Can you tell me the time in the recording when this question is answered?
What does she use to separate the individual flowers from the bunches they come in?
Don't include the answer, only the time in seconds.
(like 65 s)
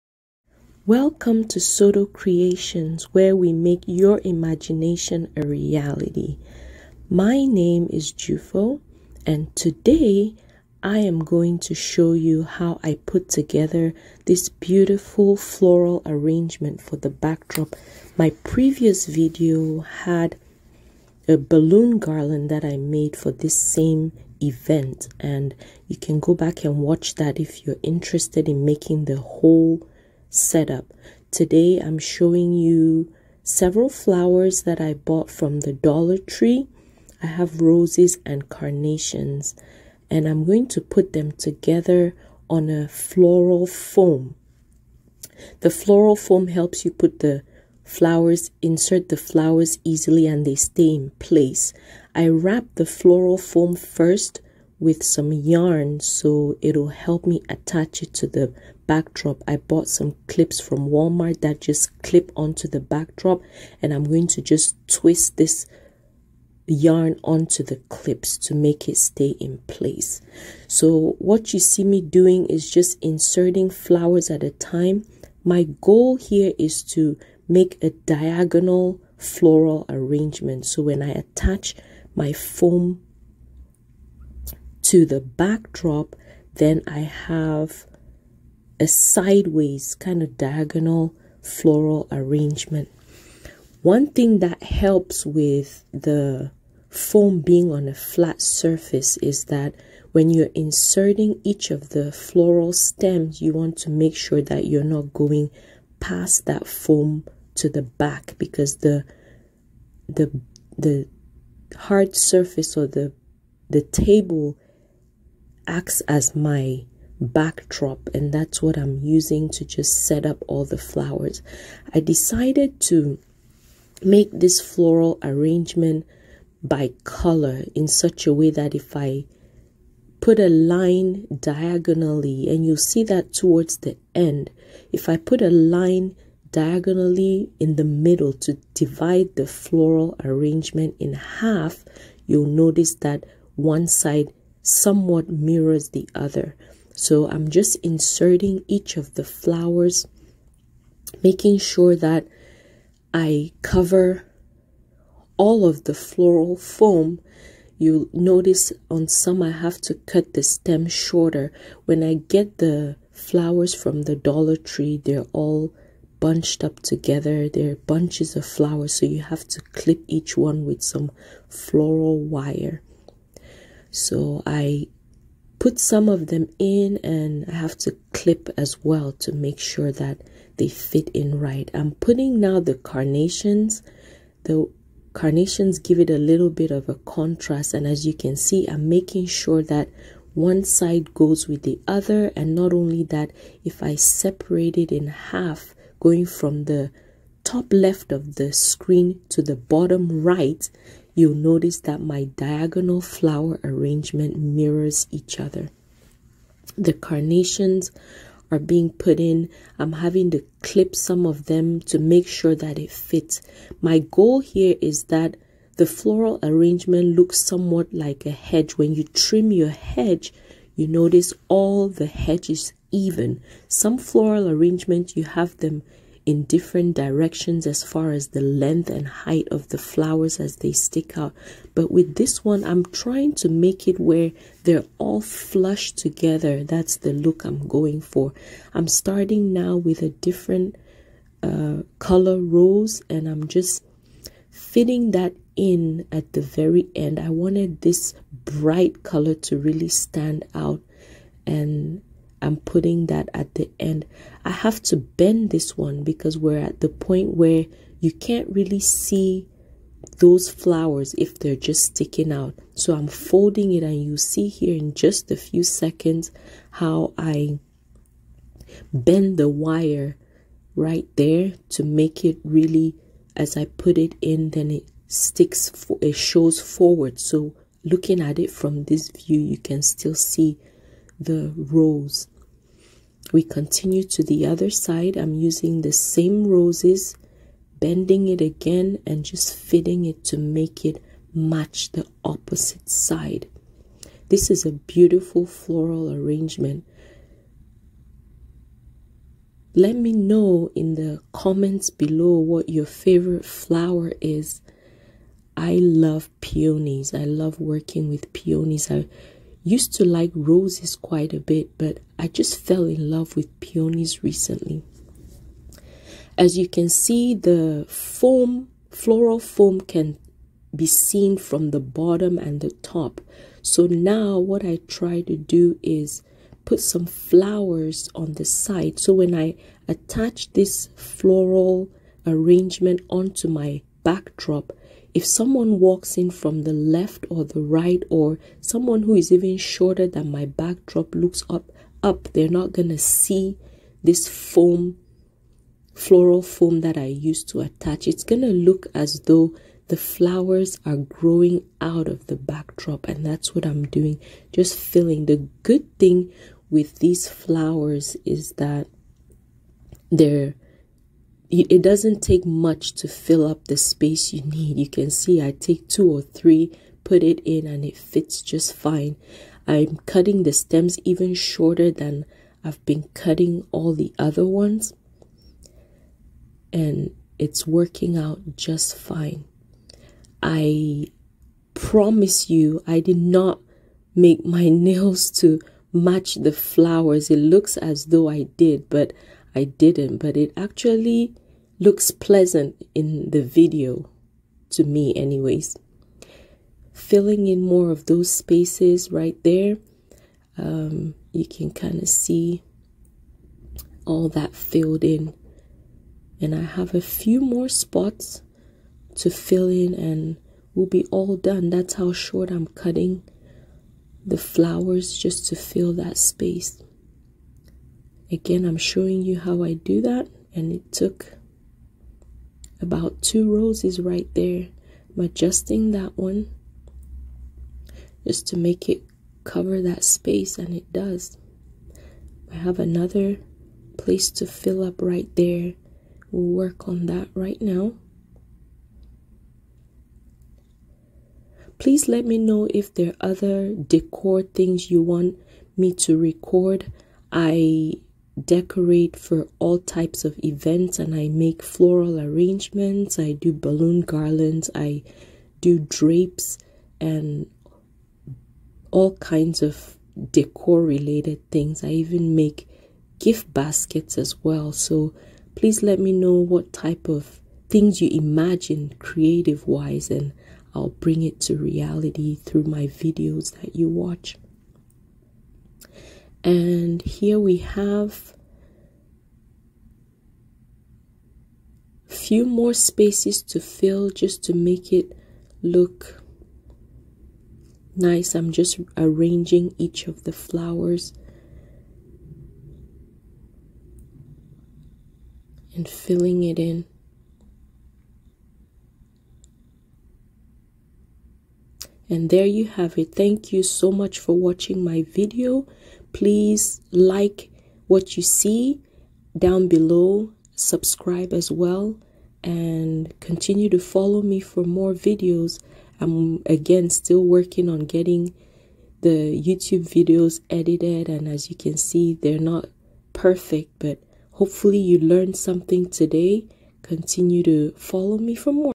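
171 s.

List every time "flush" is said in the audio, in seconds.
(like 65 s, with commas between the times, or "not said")
235 s.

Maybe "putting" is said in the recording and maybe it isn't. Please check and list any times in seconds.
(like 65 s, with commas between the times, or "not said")
181 s, 252 s.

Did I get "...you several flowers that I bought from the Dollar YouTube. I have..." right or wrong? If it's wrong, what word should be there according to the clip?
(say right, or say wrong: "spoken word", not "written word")
wrong: "Tree", not "YouTube".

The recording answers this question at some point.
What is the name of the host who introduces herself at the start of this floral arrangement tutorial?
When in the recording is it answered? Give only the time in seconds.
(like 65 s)
8 s.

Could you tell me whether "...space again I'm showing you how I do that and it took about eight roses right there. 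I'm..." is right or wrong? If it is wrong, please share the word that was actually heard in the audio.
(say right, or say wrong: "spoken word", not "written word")
wrong: "two", not "eight".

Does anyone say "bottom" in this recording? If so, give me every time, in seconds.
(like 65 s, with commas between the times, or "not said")
199 s, 321 s.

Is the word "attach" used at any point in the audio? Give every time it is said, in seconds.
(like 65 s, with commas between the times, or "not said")
57 s, 81 s, 329 s, 347 s.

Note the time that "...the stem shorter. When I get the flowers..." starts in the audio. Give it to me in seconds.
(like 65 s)
160 s.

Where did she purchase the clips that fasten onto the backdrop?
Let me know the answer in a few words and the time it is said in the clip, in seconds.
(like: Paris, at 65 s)
Walmart, at 60 s.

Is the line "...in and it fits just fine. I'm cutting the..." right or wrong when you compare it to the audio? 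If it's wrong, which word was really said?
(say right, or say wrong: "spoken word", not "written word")
right.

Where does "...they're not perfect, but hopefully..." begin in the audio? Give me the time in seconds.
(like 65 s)
522 s.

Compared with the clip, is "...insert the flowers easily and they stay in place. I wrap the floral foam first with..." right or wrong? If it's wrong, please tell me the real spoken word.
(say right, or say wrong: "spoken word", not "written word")
right.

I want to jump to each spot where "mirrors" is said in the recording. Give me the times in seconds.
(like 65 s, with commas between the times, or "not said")
145 s, 204 s.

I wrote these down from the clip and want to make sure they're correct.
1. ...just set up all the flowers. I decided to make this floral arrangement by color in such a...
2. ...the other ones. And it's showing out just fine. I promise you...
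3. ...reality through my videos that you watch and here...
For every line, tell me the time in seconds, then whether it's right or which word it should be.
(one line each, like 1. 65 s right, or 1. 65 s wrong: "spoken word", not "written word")
1. 119 s right
2. 373 s wrong: "working", not "showing"
3. 471 s right.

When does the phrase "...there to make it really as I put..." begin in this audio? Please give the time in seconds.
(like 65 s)
271 s.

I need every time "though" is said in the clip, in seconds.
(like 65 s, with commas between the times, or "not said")
349 s, 388 s.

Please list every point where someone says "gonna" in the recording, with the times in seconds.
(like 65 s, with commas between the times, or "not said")
342 s, 348 s.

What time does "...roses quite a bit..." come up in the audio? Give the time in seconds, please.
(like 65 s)
310 s.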